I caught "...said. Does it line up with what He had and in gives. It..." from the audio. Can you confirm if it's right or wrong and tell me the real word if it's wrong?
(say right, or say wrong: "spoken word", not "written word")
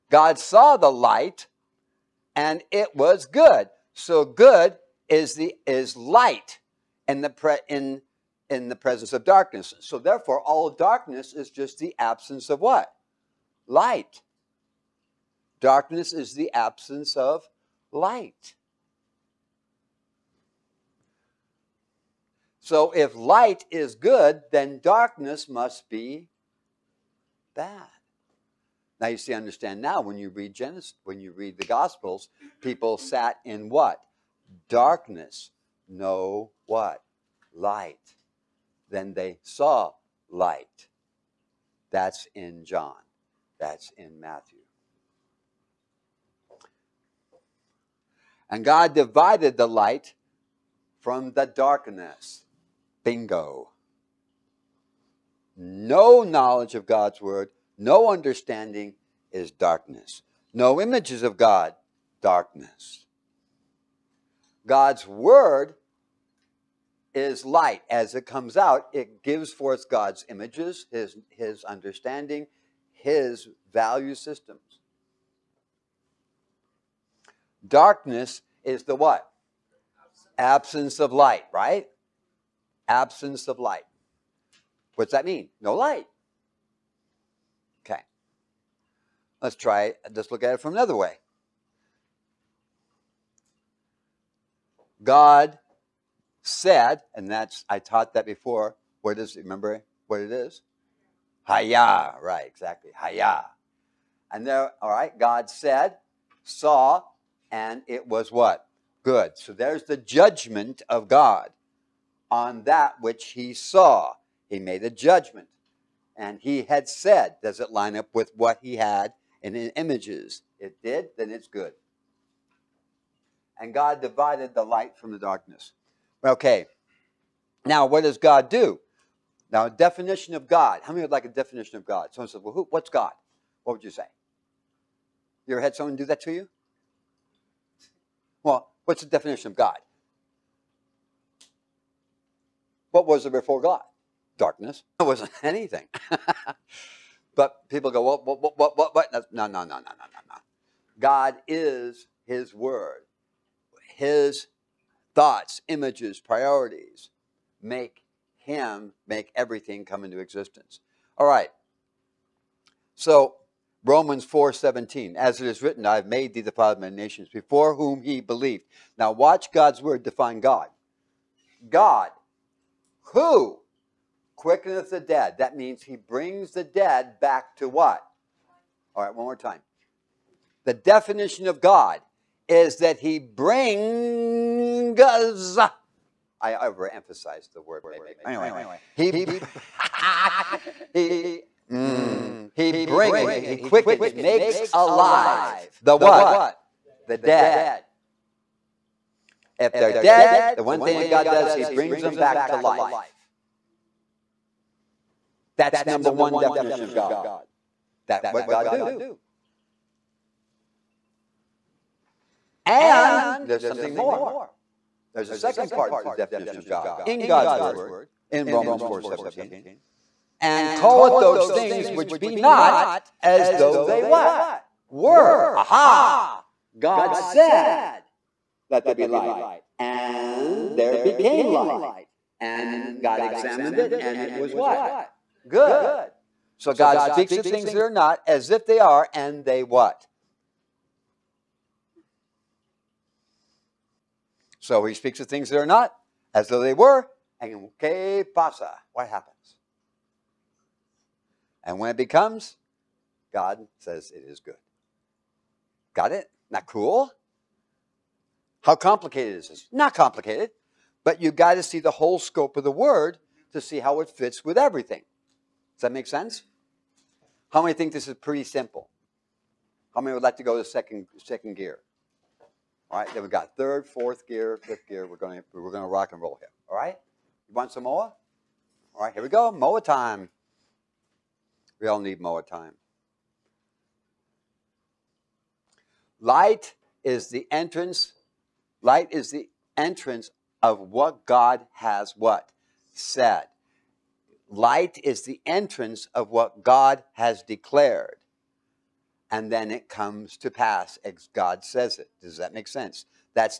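wrong: "images", not "gives".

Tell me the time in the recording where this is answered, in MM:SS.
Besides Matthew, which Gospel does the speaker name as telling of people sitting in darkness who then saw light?
00:42.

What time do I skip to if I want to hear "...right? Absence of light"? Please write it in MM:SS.
01:21.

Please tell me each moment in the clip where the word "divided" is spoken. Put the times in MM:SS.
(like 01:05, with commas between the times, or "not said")
00:48, 02:04.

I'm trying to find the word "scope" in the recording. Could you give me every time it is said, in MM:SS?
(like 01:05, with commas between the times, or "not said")
04:22.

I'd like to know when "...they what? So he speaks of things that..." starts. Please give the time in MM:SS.
03:59.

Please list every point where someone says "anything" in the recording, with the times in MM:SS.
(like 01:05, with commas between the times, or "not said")
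02:25.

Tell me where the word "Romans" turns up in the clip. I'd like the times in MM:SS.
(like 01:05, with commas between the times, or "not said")
02:43, 03:38.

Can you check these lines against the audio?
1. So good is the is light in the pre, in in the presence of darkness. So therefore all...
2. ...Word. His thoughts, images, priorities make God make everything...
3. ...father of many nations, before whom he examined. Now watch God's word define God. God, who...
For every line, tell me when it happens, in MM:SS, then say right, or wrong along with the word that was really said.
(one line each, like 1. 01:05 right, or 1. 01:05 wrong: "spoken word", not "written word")
1. 00:03 right
2. 02:32 wrong: "Him", not "God"
3. 02:46 wrong: "believed", not "examined".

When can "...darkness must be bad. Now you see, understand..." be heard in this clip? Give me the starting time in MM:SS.
00:24.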